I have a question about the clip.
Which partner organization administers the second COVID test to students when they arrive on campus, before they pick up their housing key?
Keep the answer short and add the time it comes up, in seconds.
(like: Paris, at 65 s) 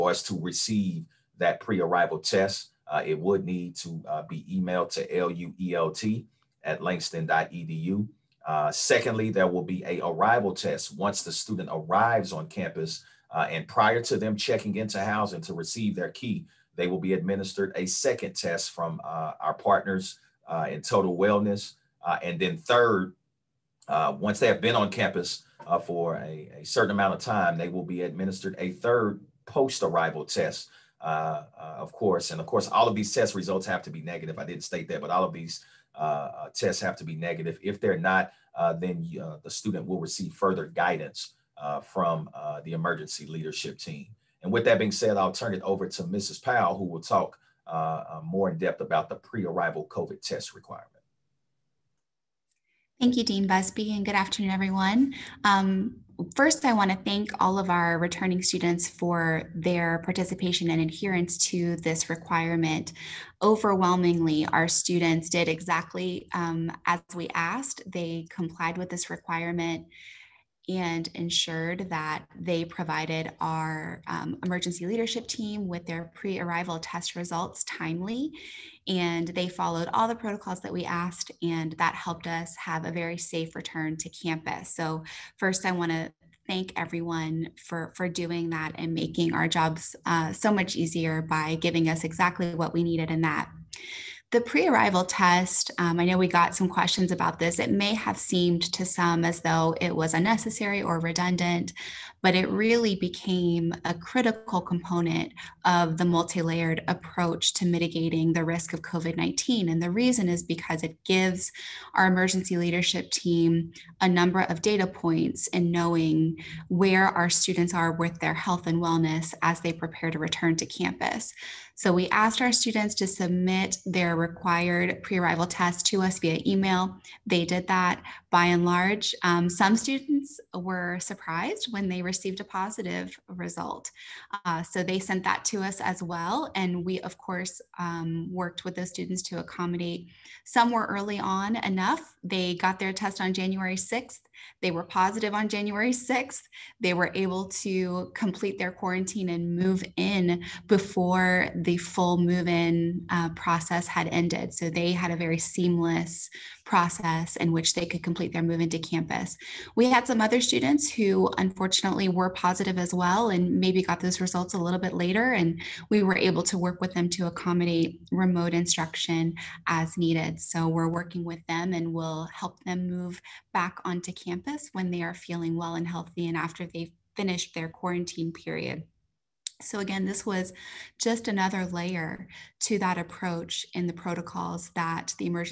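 Total Wellness, at 20 s.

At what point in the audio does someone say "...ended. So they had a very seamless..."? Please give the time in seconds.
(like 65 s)
154 s.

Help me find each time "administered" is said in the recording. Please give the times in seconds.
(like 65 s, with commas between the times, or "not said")
17 s, 28 s.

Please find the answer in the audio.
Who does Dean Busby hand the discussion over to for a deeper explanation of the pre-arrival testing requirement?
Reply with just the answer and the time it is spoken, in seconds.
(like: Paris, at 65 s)
Mrs. Powell, at 46 s.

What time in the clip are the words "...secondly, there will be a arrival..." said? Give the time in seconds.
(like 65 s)
8 s.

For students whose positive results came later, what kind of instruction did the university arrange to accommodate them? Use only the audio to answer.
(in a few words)
remote instruction.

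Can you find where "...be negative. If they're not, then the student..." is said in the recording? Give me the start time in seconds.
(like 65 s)
37 s.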